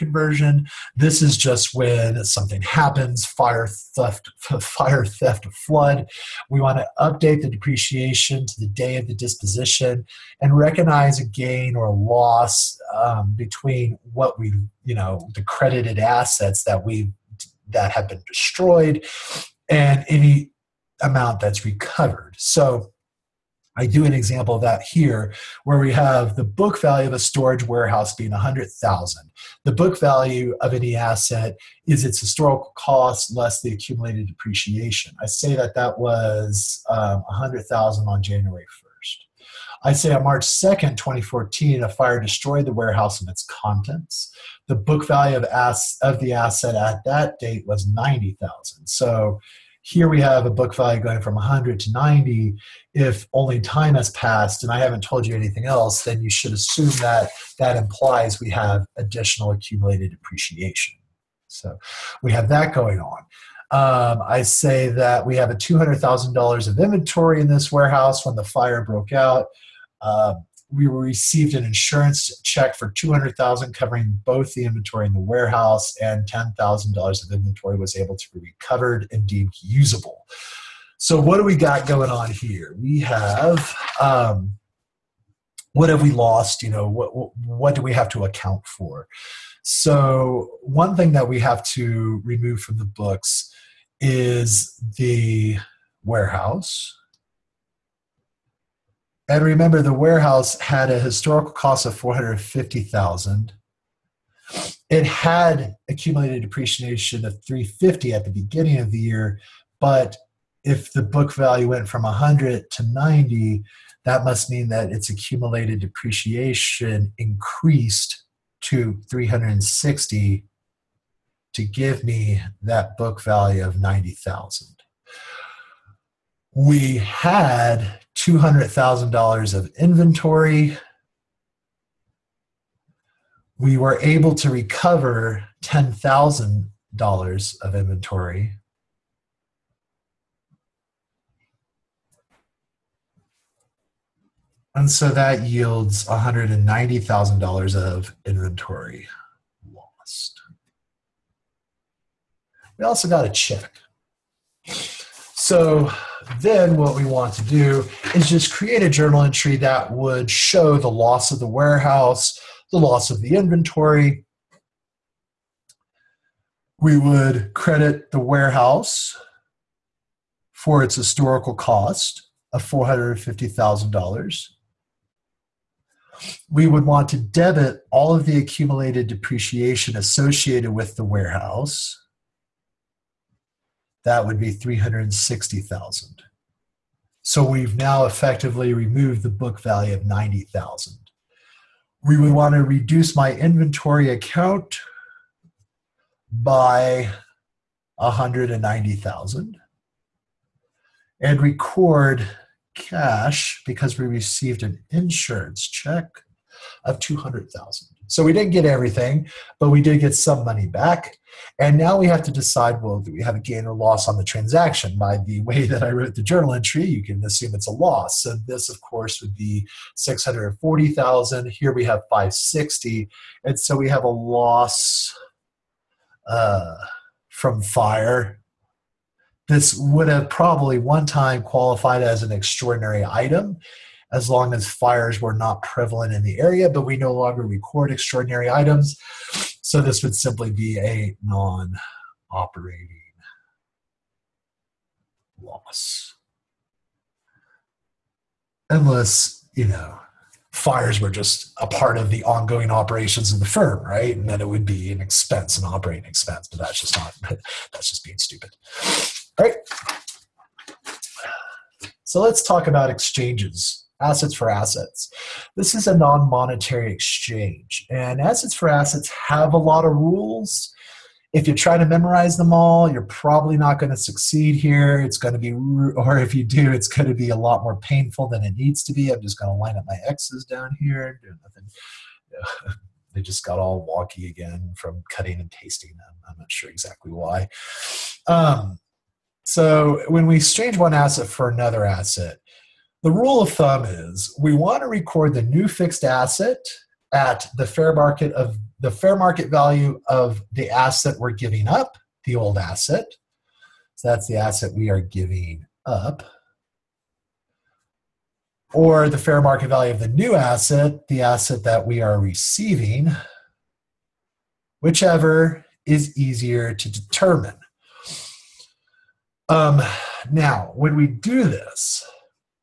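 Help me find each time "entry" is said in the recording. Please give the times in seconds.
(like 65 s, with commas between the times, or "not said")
159 s, 216 s.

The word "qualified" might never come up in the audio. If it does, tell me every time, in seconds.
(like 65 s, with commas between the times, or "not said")
231 s.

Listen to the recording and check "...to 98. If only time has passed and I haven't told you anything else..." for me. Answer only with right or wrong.
wrong.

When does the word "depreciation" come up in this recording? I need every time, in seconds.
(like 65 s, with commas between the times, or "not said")
7 s, 34 s, 60 s, 106 s, 115 s, 179 s.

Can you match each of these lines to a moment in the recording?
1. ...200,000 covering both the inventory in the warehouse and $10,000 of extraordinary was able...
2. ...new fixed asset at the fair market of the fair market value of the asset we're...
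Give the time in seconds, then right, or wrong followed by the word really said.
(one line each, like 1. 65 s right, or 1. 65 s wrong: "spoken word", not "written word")
1. 72 s wrong: "inventory", not "extraordinary"
2. 295 s right.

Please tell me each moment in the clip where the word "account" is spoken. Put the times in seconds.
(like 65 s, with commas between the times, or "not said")
88 s, 194 s.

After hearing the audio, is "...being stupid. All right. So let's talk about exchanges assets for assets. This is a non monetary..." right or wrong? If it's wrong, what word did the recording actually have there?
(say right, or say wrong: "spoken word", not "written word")
right.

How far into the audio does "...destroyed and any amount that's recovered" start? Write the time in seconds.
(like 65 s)
18 s.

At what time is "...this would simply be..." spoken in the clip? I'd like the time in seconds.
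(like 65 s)
239 s.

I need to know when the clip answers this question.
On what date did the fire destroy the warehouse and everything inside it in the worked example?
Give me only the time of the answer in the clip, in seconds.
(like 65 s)
40 s.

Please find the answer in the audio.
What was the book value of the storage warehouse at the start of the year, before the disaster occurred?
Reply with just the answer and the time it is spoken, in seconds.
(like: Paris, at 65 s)
$100,000, at 37 s.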